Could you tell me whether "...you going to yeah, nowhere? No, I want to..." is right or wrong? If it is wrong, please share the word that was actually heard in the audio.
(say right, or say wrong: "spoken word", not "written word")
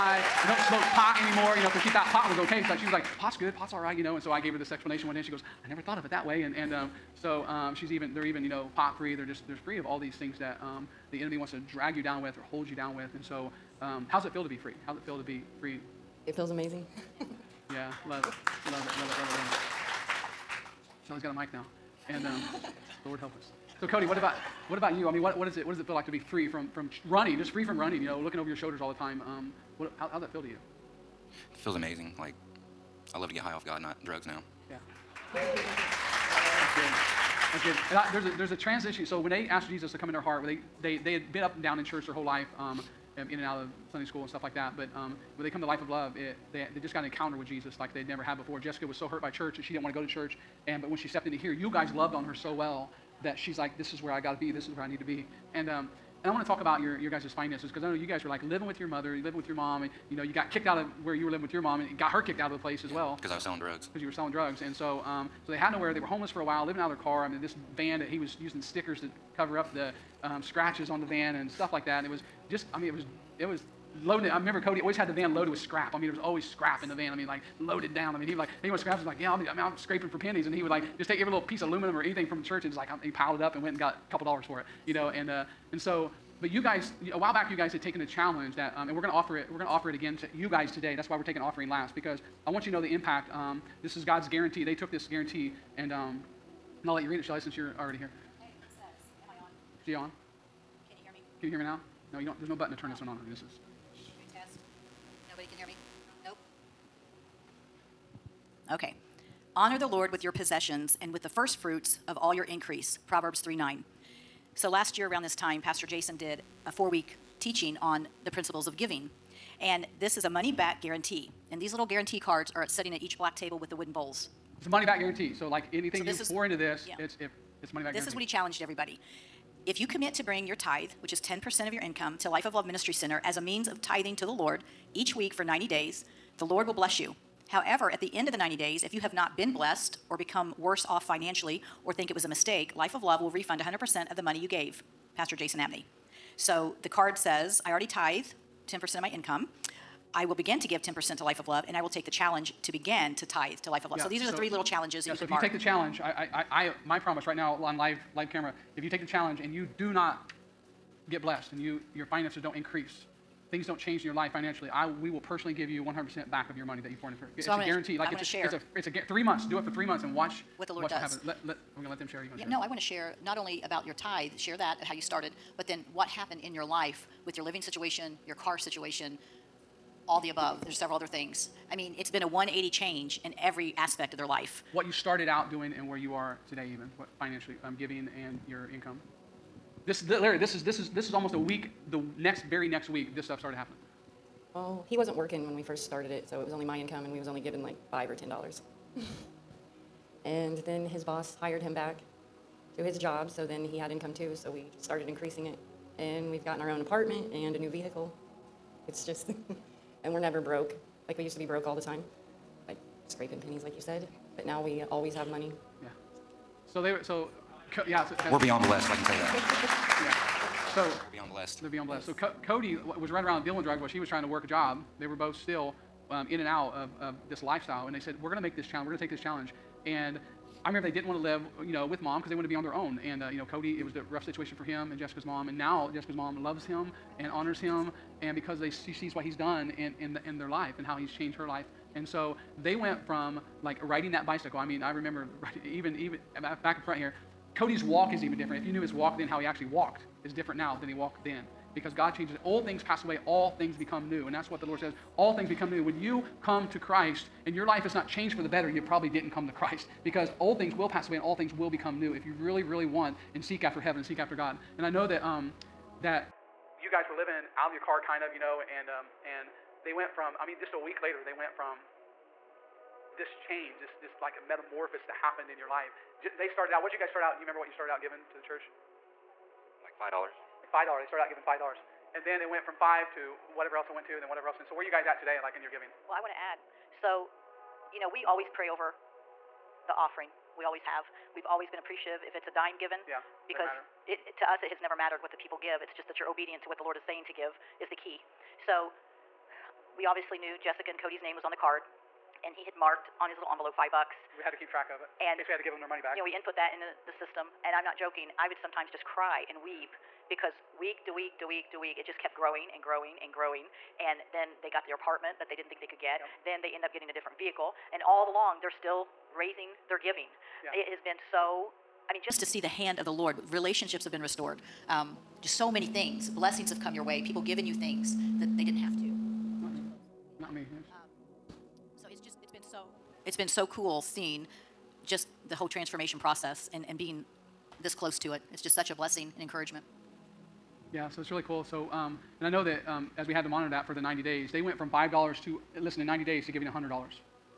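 wrong: "share", not "nowhere".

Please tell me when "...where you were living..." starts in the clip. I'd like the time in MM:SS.
01:01.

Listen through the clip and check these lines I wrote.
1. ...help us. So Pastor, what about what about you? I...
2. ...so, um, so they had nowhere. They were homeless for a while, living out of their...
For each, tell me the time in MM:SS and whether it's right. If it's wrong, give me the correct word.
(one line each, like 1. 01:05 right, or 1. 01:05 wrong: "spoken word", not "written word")
1. 00:23 wrong: "Cody", not "Pastor"
2. 01:04 right.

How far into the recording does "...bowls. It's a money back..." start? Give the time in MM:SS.
02:03.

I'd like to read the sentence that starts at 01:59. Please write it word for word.
And this is a money back guarantee.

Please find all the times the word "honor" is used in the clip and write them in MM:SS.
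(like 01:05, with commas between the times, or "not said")
01:49, 03:57.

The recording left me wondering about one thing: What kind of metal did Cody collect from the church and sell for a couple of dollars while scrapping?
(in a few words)
Aluminum.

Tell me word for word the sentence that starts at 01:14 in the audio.
I remember Cody always had the van loaded with scrap.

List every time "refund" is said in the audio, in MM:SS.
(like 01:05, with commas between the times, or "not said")
02:23.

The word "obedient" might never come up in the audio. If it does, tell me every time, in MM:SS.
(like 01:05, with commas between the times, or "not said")
04:56.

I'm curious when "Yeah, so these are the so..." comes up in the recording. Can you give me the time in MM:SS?
02:33.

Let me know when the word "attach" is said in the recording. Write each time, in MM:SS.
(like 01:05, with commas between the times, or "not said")
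not said.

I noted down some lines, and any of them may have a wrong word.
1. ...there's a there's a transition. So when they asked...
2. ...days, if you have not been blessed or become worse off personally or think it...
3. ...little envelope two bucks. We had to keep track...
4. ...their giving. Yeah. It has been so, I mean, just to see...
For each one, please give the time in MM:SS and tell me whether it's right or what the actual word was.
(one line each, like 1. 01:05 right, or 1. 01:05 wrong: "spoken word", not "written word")
1. 00:38 right
2. 02:18 wrong: "financially", not "personally"
3. 05:03 wrong: "five", not "two"
4. 05:19 right.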